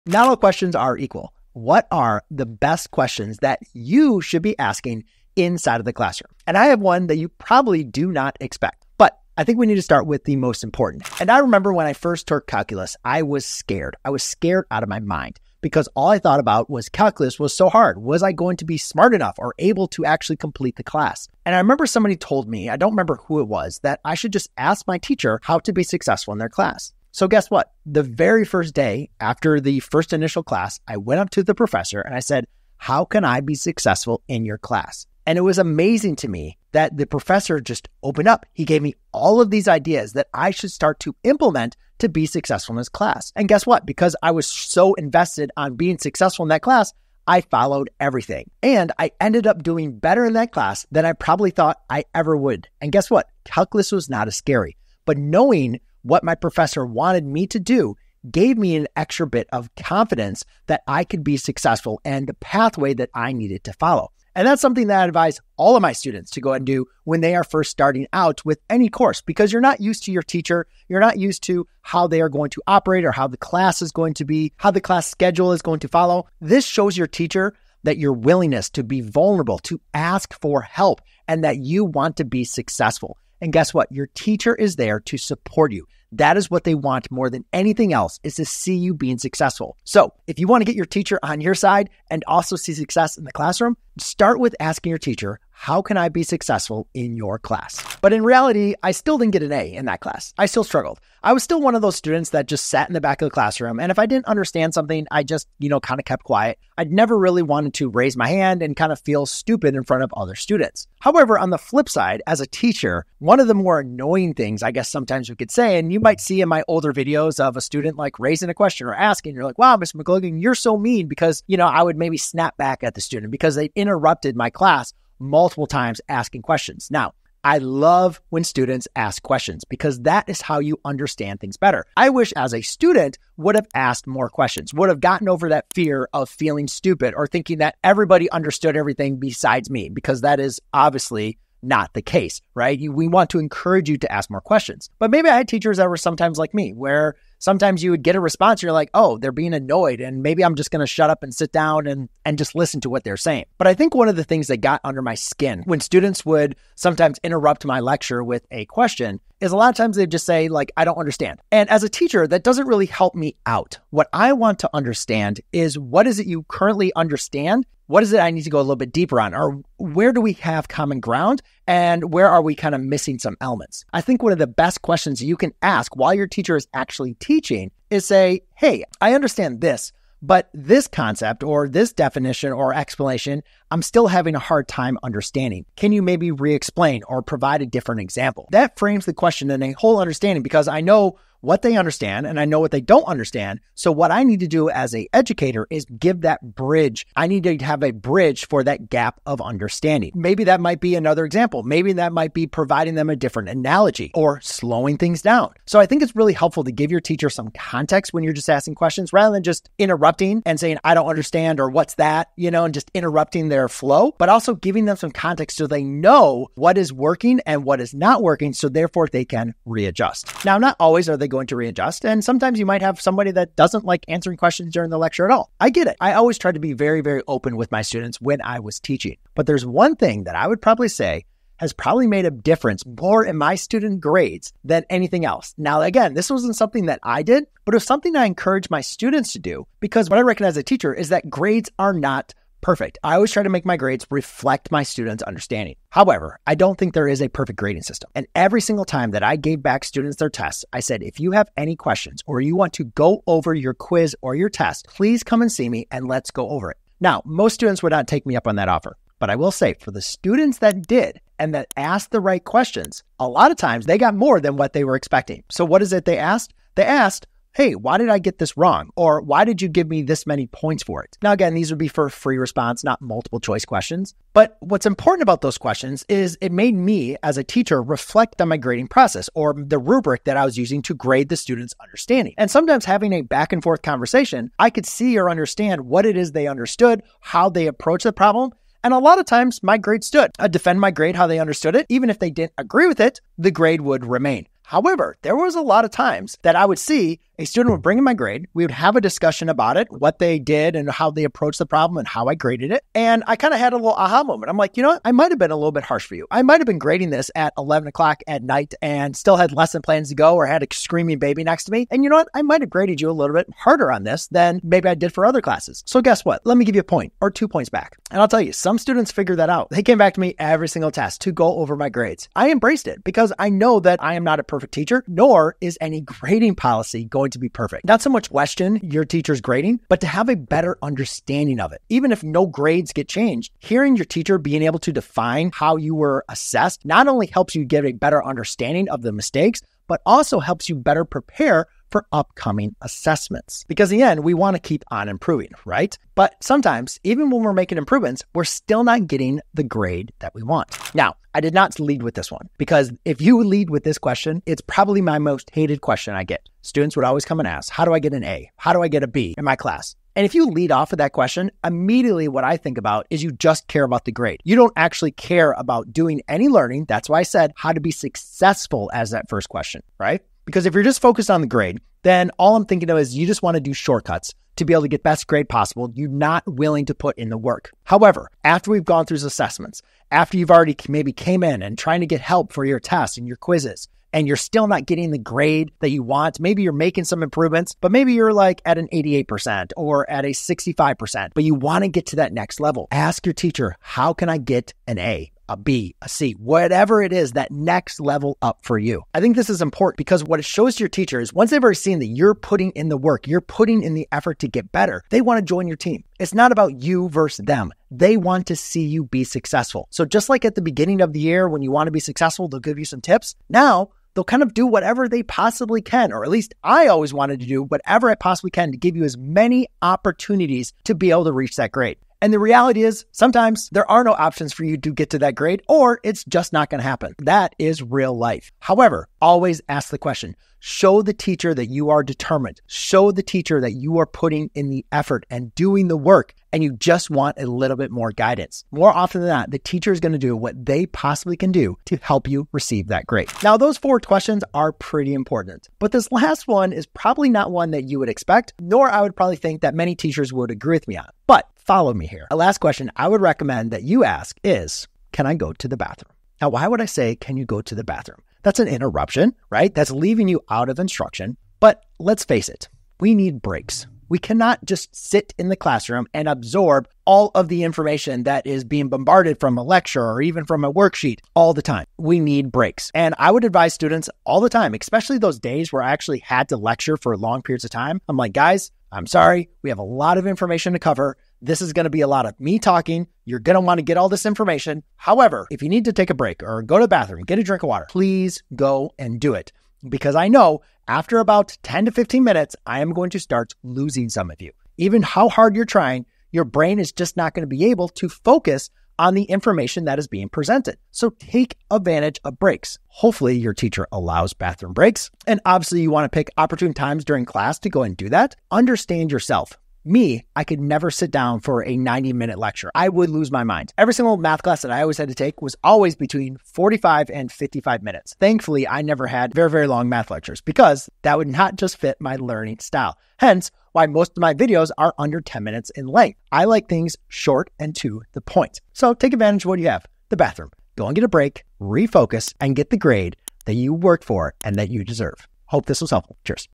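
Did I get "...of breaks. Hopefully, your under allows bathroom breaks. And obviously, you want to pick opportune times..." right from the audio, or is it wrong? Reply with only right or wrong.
wrong.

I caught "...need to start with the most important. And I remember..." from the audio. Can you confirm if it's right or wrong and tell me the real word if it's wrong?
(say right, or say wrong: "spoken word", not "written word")
right.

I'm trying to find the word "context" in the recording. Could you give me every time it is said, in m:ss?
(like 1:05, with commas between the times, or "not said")
3:27, 3:35.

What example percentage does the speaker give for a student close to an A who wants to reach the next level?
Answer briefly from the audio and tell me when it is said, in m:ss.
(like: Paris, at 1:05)
88%, at 6:28.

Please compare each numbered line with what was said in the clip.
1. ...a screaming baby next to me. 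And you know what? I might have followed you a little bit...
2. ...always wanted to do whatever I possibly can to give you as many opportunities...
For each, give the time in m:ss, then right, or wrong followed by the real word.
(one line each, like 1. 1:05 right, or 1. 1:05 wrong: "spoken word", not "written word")
1. 5:10 wrong: "graded", not "followed"
2. 6:56 right.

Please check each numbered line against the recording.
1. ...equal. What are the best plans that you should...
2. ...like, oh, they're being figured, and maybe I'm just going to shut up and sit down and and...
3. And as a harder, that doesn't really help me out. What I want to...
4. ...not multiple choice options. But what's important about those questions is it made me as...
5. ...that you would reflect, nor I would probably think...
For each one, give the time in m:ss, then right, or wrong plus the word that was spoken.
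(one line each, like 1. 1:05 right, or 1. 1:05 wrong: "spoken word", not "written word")
1. 0:00 wrong: "questions", not "plans"
2. 2:28 wrong: "annoyed", not "figured"
3. 2:41 wrong: "teacher", not "harder"
4. 4:32 wrong: "questions", not "options"
5. 7:27 wrong: "expect", not "reflect".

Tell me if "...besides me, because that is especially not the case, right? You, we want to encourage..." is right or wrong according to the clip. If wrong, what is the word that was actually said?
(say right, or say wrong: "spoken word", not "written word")
wrong: "obviously", not "especially".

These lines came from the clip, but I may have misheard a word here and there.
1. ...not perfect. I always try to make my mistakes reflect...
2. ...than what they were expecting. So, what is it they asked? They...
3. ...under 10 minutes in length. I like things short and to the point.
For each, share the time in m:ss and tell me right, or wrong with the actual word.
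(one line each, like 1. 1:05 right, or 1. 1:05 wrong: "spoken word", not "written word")
1. 4:01 wrong: "grades", not "mistakes"
2. 4:24 right
3. 8:44 right.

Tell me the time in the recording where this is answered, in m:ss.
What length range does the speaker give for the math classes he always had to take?
8:36.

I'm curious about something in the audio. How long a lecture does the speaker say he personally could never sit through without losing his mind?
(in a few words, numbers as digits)
90 minutes.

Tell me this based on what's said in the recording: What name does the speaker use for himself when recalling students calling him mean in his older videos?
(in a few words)
Mr. McLogan.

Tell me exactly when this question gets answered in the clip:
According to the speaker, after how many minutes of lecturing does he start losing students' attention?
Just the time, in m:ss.
8:11.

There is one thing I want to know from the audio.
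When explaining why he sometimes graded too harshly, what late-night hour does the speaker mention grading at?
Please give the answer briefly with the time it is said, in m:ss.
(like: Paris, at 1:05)
11 o'clock, at 5:07.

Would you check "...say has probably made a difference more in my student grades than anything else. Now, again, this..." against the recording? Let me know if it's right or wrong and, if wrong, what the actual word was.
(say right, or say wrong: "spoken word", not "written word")
right.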